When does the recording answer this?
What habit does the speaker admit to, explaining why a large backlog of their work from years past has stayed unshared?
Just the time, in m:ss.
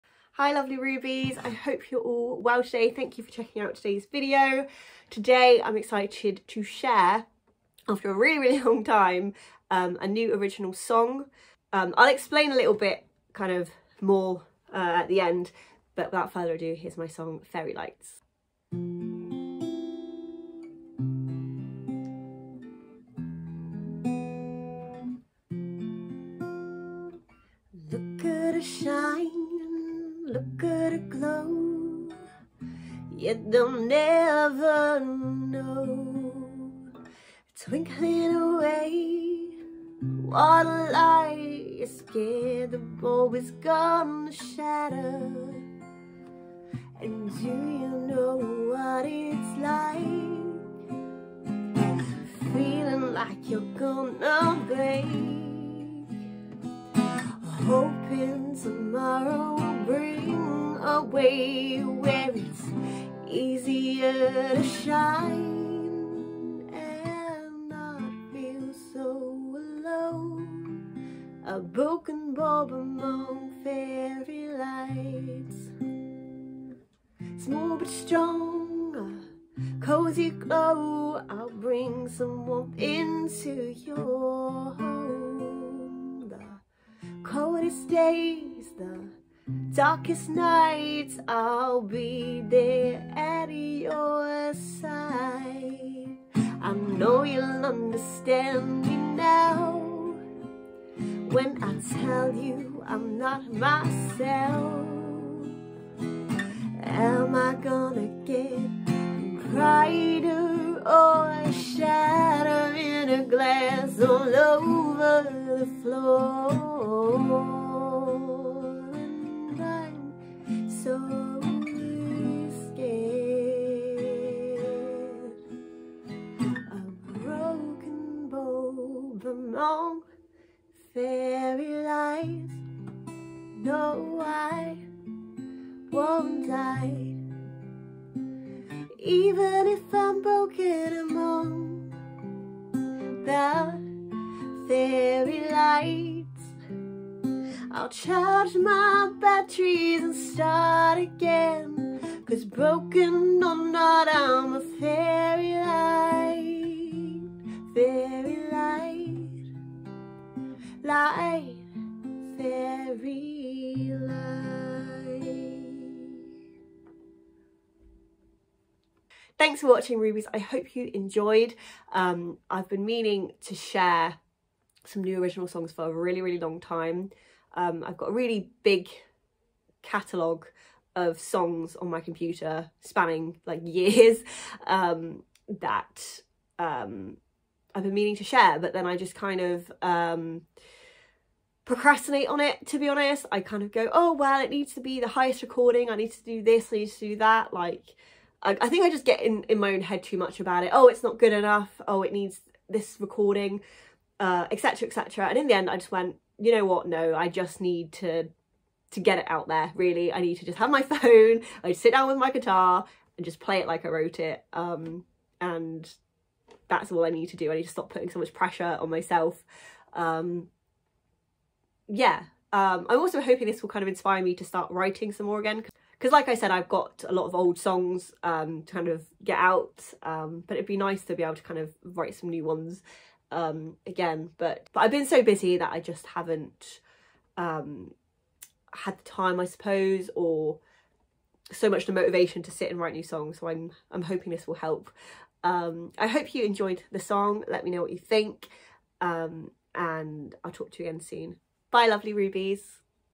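3:11.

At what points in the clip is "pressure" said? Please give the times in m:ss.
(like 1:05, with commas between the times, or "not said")
3:38.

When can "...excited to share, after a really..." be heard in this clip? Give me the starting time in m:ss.
0:05.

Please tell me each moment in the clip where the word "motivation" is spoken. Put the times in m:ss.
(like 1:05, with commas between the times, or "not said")
4:01.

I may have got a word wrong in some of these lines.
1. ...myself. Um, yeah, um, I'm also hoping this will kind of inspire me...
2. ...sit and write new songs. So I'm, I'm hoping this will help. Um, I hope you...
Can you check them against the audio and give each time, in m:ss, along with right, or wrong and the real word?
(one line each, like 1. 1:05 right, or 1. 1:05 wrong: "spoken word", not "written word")
1. 3:38 right
2. 4:02 right.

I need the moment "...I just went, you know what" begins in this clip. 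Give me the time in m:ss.
3:25.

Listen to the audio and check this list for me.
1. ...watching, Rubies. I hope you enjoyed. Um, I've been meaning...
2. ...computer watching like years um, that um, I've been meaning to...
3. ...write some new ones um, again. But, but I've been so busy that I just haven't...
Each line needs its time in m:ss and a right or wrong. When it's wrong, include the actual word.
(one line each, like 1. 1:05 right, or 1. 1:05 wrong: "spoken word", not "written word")
1. 2:49 right
2. 3:02 wrong: "spanning", not "watching"
3. 3:51 right.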